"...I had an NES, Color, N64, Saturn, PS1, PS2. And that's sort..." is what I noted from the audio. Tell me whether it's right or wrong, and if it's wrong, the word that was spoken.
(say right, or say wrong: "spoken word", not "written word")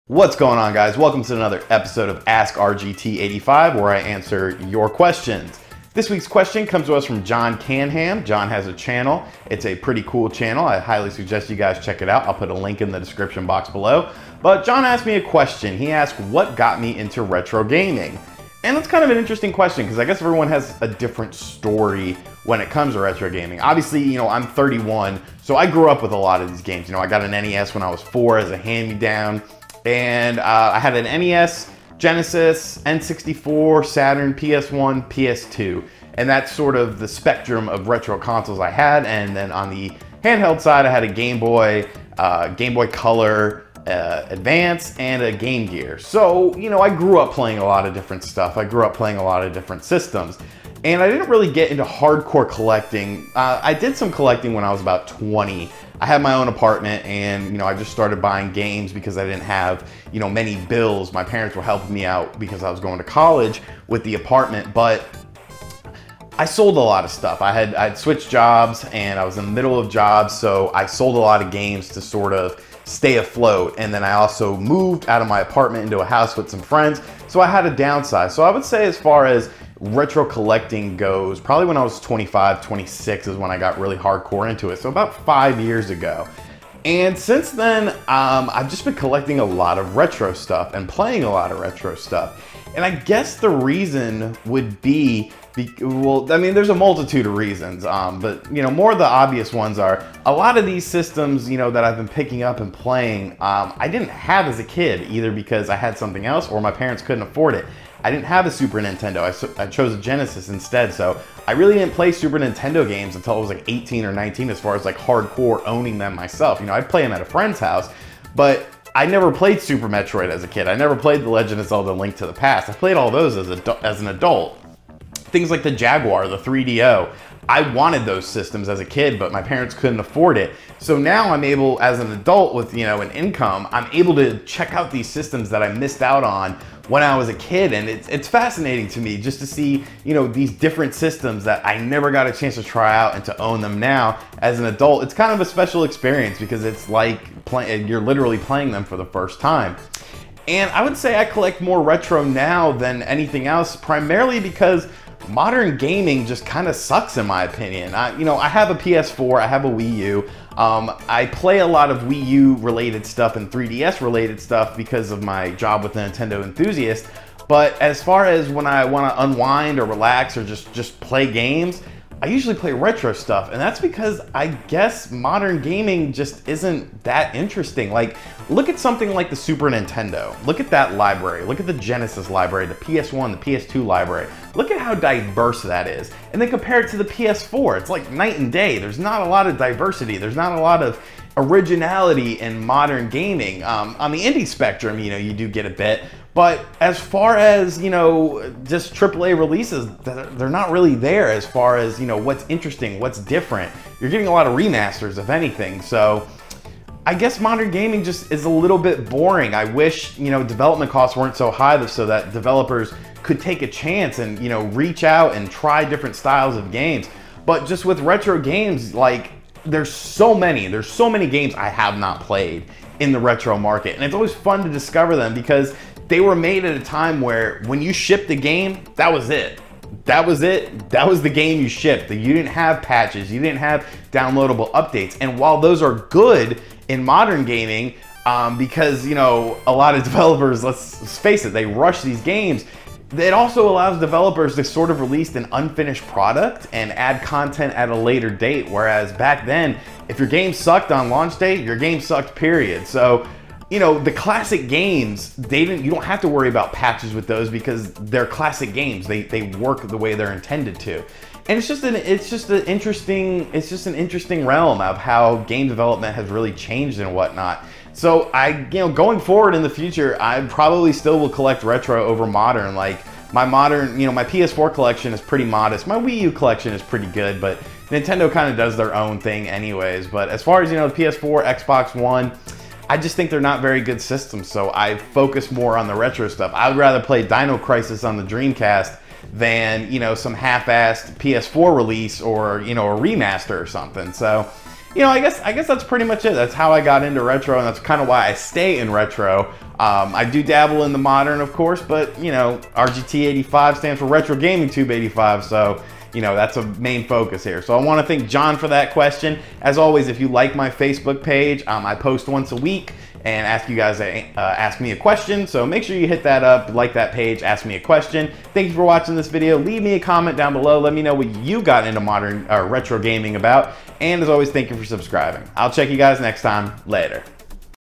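wrong: "Genesis", not "Color".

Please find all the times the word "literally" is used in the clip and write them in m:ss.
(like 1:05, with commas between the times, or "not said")
2:28.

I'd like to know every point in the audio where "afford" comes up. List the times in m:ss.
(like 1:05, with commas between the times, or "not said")
1:47, 2:09.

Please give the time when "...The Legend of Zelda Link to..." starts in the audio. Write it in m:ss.
2:01.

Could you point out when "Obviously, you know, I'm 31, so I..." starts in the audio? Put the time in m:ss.
0:23.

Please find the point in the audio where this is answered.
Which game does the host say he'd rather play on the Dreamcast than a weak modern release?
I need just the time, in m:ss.
4:47.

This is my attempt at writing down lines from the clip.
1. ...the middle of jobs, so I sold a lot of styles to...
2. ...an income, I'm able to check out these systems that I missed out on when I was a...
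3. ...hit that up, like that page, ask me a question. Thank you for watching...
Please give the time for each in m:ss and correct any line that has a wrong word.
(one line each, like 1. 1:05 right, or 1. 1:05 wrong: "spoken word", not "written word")
1. 1:09 wrong: "games", not "styles"
2. 2:13 right
3. 5:16 right.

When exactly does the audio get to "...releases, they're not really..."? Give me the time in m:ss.
3:19.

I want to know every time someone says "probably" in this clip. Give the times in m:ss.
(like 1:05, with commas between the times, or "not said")
1:21, 4:30.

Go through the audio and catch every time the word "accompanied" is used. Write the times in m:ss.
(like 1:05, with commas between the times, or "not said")
not said.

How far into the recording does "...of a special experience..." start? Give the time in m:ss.
2:25.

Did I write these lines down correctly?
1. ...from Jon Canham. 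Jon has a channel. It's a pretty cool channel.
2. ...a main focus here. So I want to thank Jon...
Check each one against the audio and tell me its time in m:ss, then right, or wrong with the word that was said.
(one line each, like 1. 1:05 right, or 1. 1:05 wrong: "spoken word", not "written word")
1. 0:07 right
2. 5:06 right.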